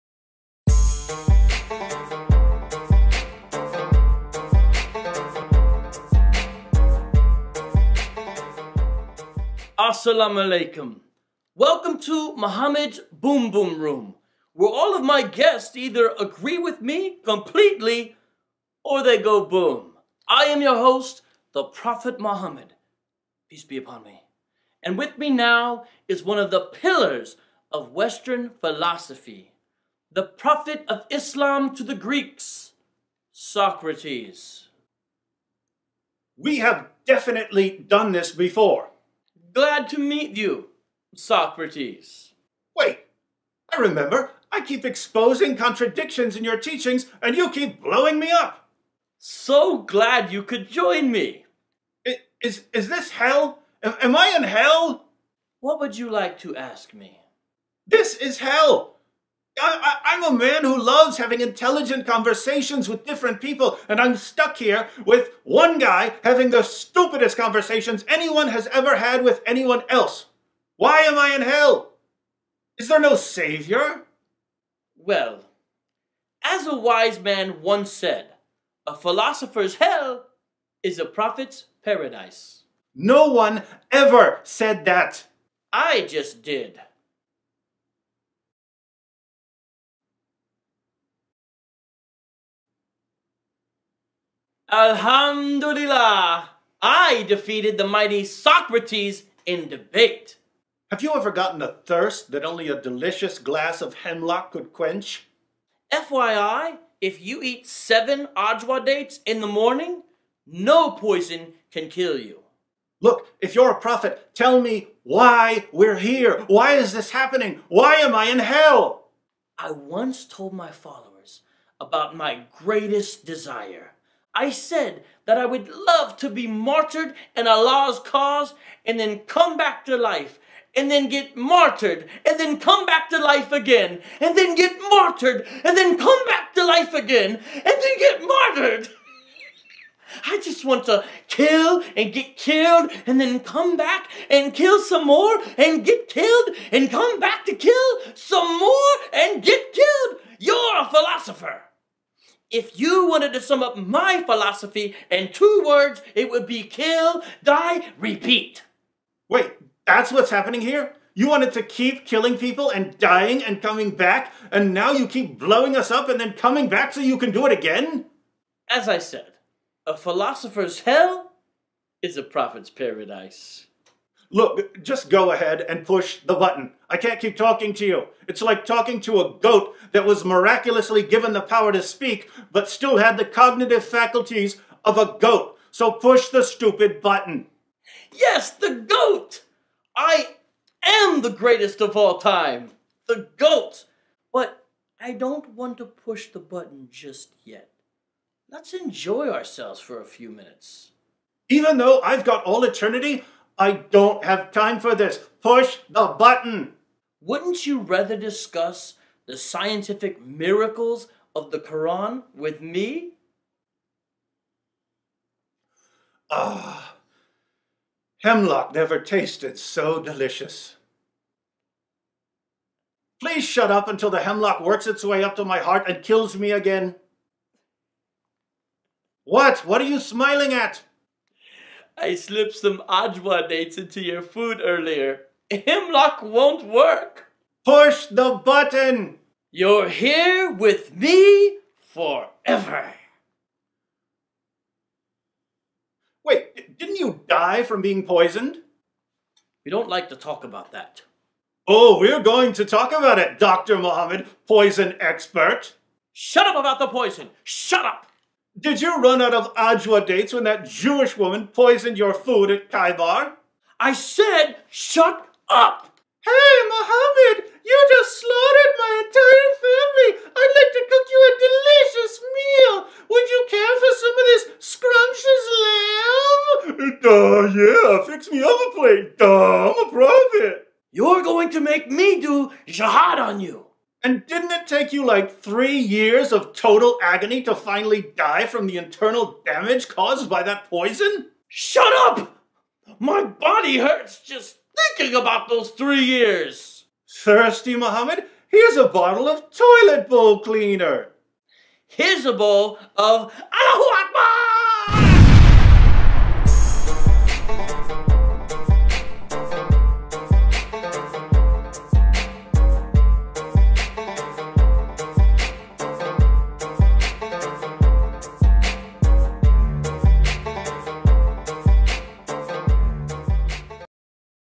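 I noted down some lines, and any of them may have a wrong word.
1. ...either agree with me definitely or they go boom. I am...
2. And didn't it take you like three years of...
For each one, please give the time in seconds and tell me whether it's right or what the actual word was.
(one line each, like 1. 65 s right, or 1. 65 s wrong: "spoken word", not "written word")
1. 15 s wrong: "completely", not "definitely"
2. 284 s right.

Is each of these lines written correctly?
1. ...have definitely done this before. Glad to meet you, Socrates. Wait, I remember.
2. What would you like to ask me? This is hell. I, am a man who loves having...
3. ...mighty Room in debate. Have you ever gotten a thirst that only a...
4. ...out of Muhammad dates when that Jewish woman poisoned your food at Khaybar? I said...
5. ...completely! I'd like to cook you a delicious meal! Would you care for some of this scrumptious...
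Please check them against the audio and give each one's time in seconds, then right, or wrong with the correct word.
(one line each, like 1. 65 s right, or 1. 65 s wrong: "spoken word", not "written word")
1. 36 s right
2. 55 s right
3. 97 s wrong: "Socrates", not "Room"
4. 259 s wrong: "Ajwa", not "Muhammad"
5. 269 s wrong: "family", not "completely".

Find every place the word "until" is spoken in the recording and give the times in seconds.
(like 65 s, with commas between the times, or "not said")
223 s.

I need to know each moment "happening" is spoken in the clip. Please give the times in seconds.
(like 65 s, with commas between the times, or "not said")
117 s, 160 s.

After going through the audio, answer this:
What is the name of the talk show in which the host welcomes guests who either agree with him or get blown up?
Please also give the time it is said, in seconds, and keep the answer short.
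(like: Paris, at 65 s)
Muhammad's Boom Boom Room, at 12 s.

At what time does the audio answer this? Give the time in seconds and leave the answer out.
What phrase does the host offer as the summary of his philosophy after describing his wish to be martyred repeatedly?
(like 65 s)
156 s.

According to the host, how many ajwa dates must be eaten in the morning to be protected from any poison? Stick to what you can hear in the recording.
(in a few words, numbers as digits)
7.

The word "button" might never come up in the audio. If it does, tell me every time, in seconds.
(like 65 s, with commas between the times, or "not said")
176 s, 187 s, 196 s, 206 s, 238 s.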